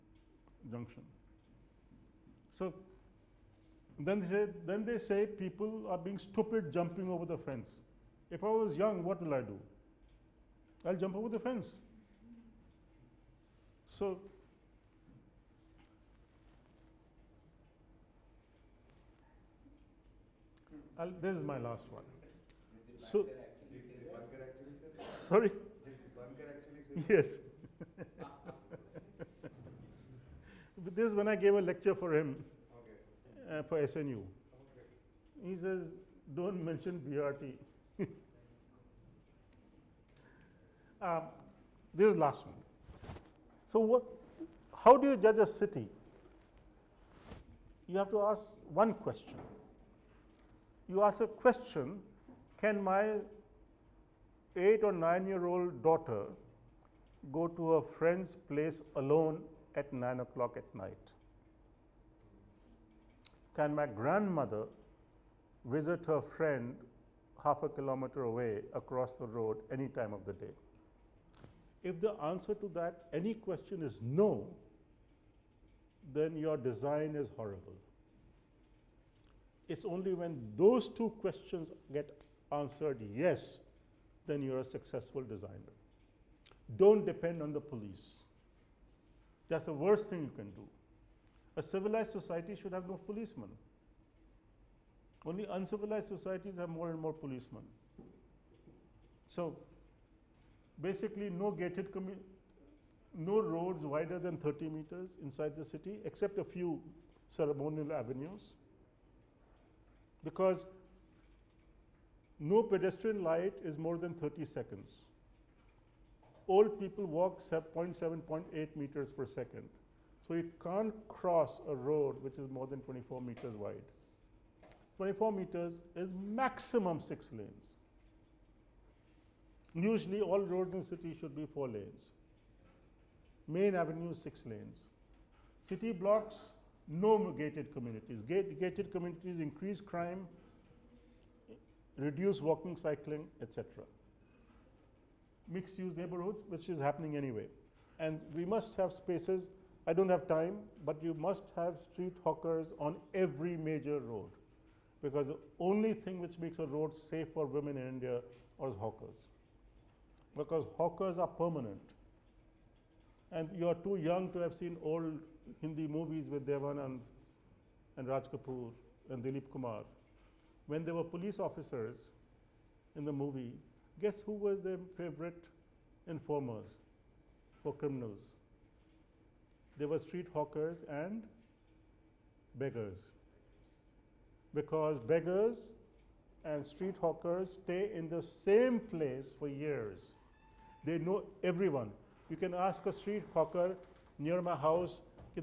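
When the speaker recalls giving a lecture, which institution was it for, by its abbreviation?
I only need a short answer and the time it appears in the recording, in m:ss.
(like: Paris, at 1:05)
SNU, at 0:33.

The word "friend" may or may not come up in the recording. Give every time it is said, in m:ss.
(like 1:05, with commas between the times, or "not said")
0:57, 1:06.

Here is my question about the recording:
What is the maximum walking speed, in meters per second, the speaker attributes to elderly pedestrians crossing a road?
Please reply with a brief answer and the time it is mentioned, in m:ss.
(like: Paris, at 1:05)
0.8, at 1:58.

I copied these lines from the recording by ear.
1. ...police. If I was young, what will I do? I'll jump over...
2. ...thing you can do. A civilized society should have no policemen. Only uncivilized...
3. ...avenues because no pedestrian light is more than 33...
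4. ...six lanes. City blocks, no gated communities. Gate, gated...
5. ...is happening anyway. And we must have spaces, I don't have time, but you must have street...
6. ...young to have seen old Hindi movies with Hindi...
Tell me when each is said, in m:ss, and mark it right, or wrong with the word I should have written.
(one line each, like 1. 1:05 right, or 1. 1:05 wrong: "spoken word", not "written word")
1. 0:07 wrong: "fence", not "police"
2. 1:30 right
3. 1:47 wrong: "30", not "33"
4. 2:14 right
5. 2:26 right
6. 2:43 wrong: "Devanand", not "Hindi".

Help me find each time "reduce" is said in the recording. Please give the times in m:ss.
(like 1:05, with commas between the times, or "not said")
2:21.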